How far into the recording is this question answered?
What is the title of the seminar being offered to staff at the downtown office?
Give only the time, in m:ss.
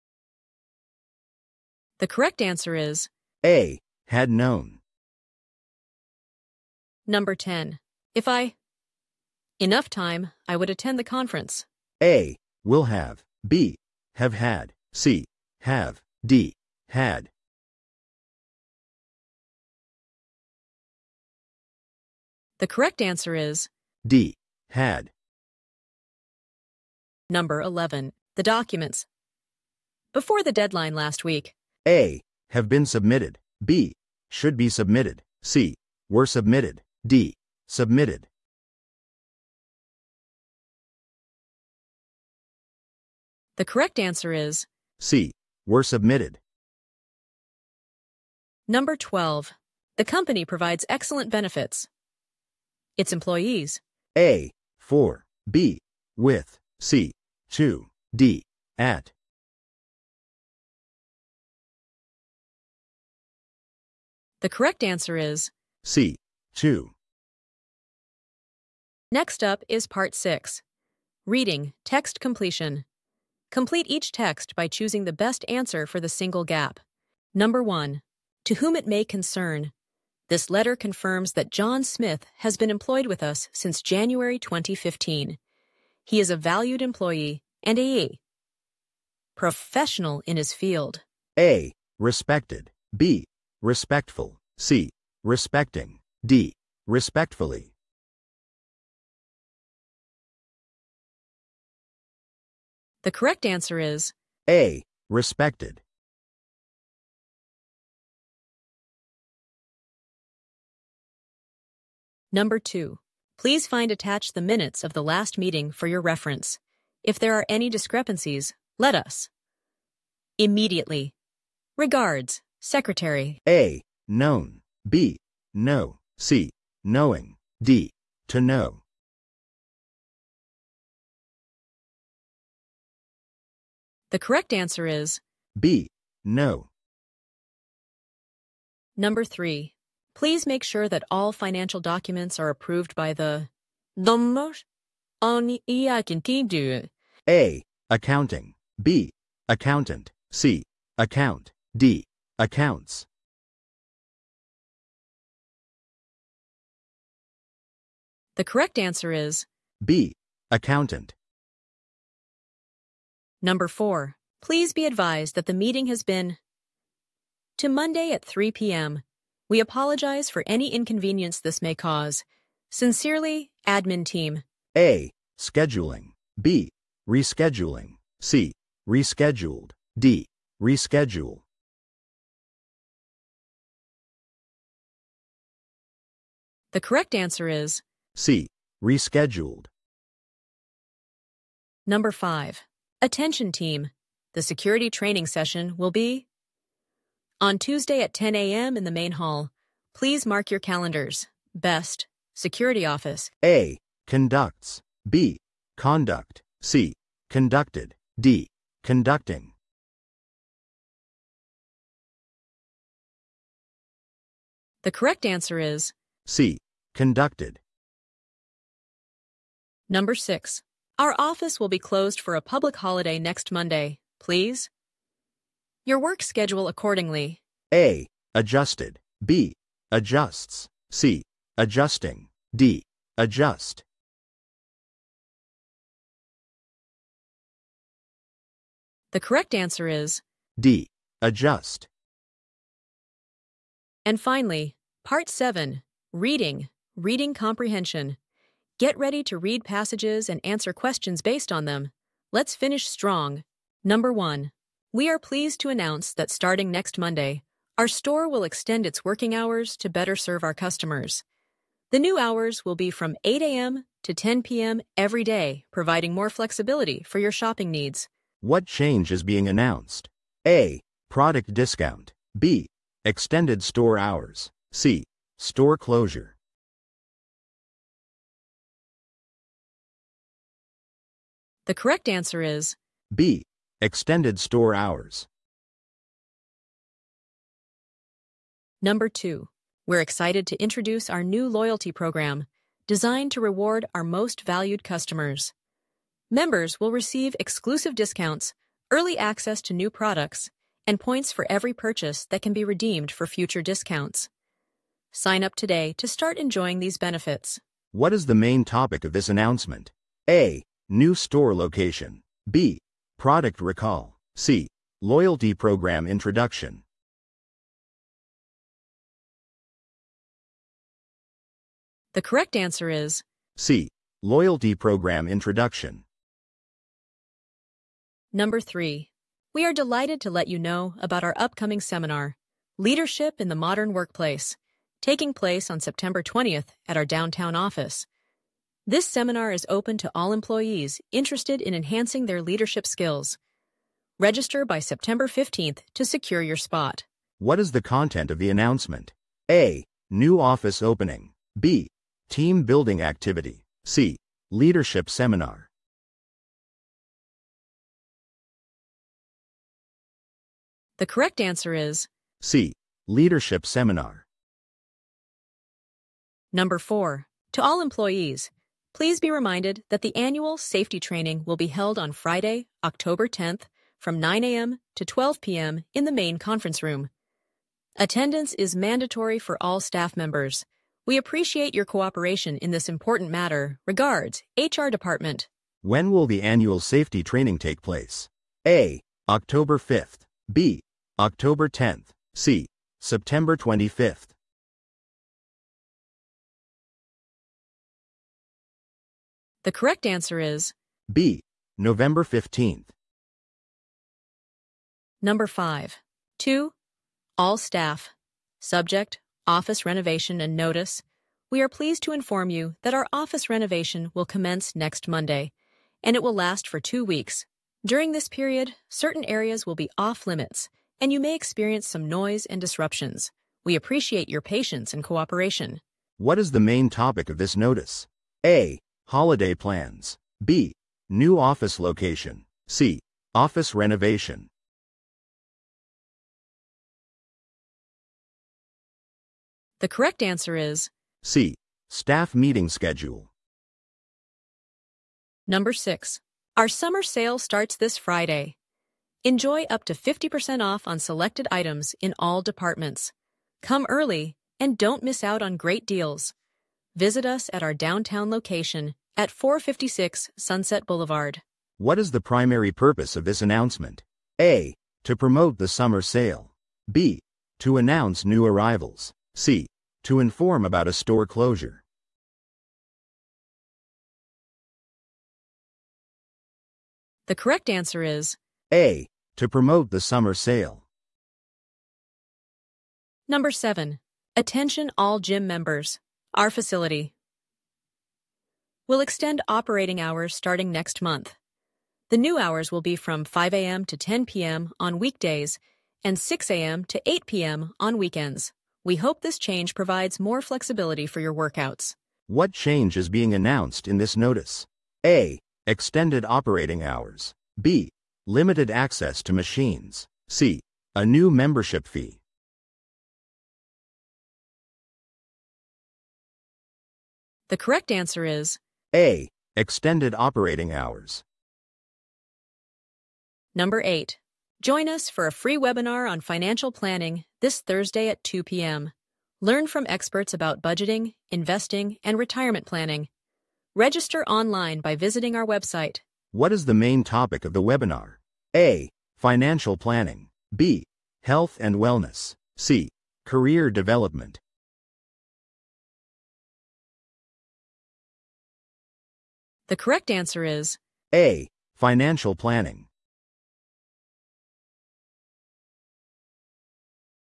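5:32.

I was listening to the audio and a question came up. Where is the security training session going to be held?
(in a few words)
the main hall.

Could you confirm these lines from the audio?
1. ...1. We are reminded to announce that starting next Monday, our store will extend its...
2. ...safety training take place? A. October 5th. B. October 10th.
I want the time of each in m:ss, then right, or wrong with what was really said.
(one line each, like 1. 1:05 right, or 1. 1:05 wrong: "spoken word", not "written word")
1. 4:14 wrong: "pleased", not "reminded"
2. 6:26 right.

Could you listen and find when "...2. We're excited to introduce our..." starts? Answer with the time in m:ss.
4:49.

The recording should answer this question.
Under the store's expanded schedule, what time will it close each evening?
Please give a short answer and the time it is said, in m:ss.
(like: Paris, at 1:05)
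10 p.m., at 4:24.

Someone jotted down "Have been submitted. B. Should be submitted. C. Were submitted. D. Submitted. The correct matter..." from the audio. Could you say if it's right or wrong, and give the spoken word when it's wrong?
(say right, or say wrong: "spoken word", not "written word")
wrong: "answer", not "matter".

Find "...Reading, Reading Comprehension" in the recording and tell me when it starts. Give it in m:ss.
4:06.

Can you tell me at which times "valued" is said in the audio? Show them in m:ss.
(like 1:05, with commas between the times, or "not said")
1:26, 4:54.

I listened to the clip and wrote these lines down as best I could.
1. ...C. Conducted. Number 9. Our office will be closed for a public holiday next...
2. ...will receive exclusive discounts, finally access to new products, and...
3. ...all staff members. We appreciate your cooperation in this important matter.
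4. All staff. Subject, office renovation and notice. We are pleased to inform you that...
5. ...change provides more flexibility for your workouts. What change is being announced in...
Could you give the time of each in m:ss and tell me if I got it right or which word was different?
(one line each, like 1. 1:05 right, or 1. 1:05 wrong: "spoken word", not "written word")
1. 3:36 wrong: "6", not "9"
2. 4:56 wrong: "early", not "finally"
3. 6:19 right
4. 6:47 right
5. 8:19 right.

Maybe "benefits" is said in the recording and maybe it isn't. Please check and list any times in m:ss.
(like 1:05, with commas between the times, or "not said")
0:51, 5:06.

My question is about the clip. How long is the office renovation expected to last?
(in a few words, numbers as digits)
two weeks.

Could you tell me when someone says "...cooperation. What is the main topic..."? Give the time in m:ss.
7:05.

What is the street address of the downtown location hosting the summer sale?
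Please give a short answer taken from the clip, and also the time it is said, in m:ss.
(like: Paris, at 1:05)
456 Sunset Boulevard, at 7:39.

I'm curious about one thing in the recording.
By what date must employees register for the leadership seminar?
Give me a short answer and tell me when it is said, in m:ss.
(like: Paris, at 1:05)
September 15th, at 5:44.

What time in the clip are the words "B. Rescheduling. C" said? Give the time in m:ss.
2:56.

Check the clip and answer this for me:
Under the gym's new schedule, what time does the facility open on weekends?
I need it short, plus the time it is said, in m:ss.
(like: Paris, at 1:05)
6 a.m., at 8:16.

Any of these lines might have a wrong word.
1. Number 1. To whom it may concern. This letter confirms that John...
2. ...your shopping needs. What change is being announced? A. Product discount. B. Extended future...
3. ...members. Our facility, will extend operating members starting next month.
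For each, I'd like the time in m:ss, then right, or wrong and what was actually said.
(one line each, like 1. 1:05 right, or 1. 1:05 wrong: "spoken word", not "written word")
1. 1:17 right
2. 4:27 wrong: "store", not "future"
3. 8:05 wrong: "hours", not "members".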